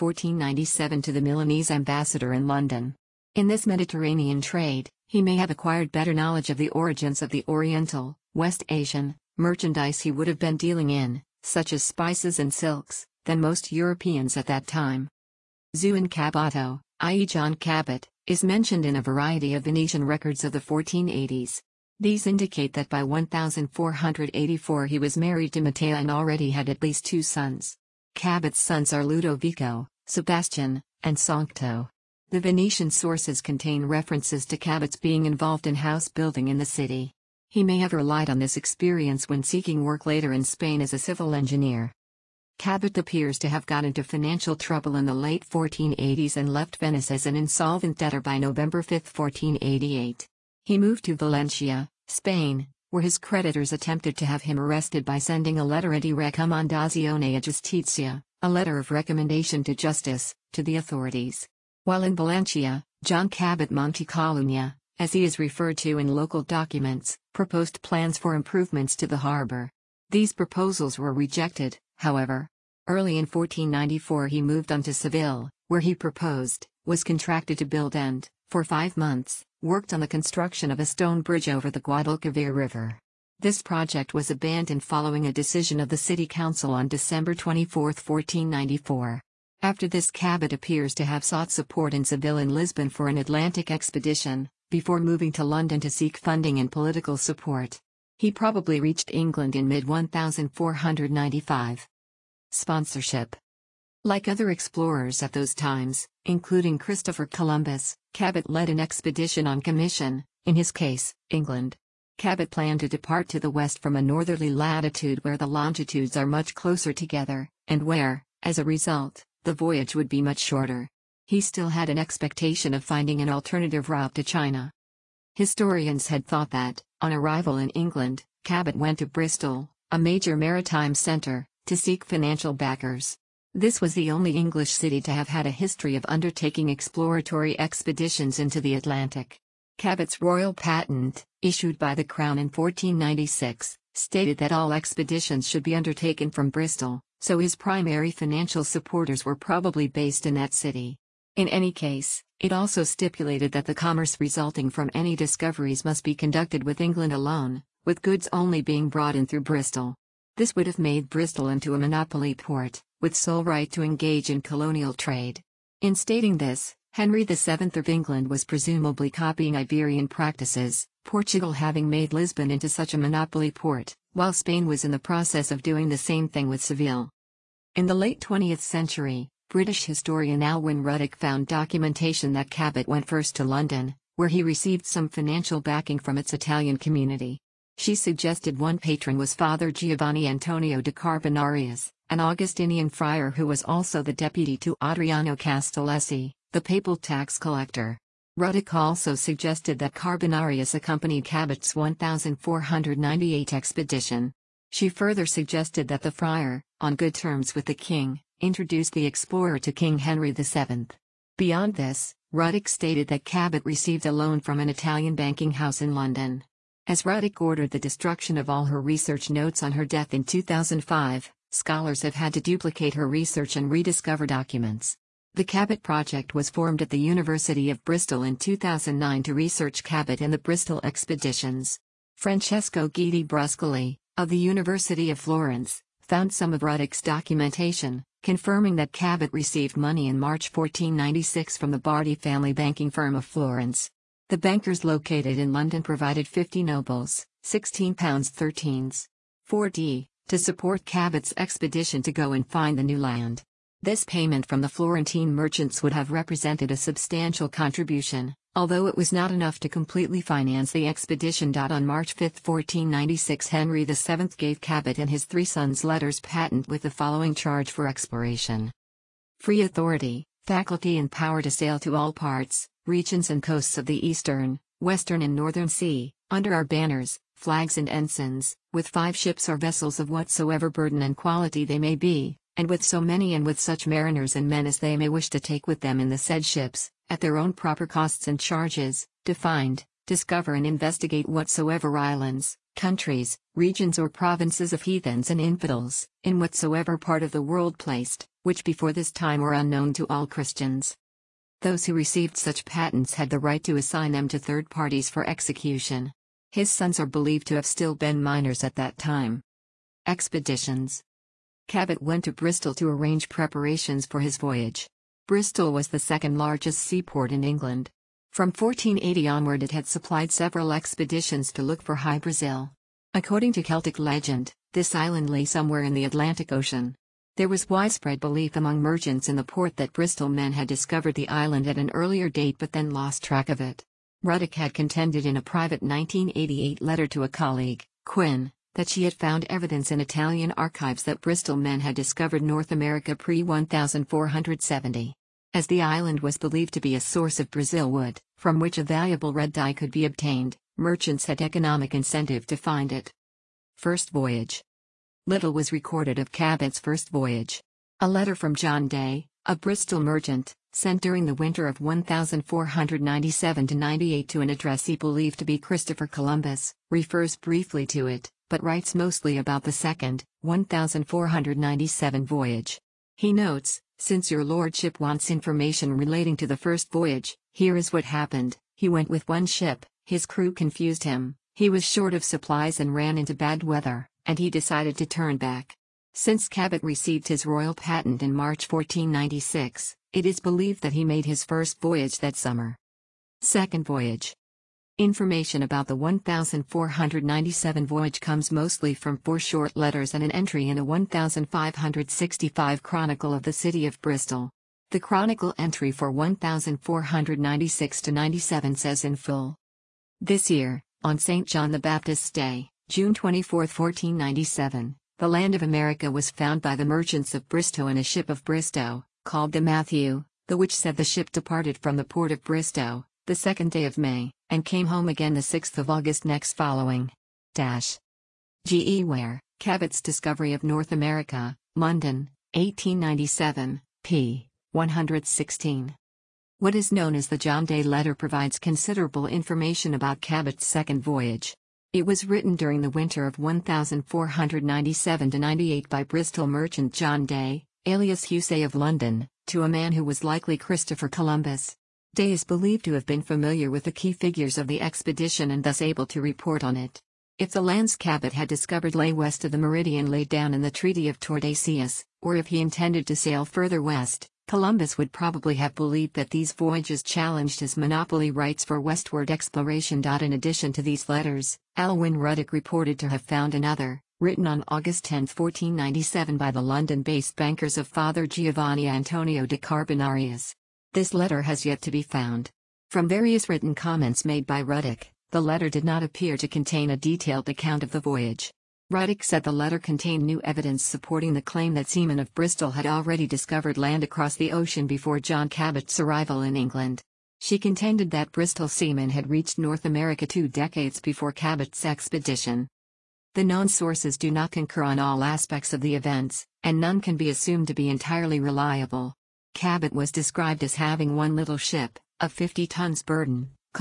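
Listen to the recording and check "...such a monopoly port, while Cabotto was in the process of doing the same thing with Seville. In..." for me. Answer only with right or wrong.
wrong.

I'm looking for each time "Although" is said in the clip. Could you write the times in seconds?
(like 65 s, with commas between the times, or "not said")
258 s.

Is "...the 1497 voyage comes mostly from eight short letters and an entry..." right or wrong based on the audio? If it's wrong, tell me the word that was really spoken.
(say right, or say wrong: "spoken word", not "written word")
wrong: "four", not "eight".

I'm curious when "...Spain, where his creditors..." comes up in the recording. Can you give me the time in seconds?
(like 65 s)
52 s.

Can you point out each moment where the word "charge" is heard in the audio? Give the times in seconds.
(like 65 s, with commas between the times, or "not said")
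267 s, 288 s.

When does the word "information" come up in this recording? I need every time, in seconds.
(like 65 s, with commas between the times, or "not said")
375 s, 394 s, 439 s.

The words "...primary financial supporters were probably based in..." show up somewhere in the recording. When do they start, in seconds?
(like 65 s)
147 s.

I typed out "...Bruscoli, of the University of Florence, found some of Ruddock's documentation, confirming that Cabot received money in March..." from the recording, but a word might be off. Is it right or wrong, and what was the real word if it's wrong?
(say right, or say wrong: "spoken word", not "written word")
right.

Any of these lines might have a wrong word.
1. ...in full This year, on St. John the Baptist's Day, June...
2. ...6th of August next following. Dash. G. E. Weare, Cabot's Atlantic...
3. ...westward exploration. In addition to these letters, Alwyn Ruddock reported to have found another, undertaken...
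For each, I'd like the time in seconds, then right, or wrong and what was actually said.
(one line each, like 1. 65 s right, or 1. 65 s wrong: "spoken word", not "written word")
1. 409 s right
2. 425 s wrong: "Discovery", not "Atlantic"
3. 468 s wrong: "written", not "undertaken".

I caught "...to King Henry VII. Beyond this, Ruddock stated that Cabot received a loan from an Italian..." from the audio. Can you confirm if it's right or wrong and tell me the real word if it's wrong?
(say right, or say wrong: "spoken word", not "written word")
right.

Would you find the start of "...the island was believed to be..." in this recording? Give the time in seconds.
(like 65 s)
345 s.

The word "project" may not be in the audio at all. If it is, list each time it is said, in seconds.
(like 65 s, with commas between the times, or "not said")
83 s, 225 s.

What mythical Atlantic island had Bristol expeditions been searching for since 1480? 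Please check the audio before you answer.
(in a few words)
High Brazil.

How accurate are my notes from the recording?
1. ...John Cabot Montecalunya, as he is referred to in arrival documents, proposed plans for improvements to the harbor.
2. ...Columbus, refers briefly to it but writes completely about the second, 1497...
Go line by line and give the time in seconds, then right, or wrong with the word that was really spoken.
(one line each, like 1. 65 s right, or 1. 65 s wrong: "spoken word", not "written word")
1. 63 s wrong: "local", not "arrival"
2. 366 s wrong: "mostly", not "completely".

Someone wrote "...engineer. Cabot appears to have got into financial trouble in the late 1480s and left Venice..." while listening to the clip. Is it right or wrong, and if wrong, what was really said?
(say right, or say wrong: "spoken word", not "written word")
right.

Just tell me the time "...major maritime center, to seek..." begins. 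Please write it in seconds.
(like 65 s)
129 s.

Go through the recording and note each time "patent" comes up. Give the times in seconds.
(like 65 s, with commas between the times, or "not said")
140 s, 266 s, 302 s, 387 s.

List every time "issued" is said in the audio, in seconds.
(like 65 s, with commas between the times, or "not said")
141 s.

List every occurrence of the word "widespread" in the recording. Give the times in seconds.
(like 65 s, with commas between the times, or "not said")
327 s.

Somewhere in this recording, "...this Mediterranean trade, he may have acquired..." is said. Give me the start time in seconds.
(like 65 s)
3 s.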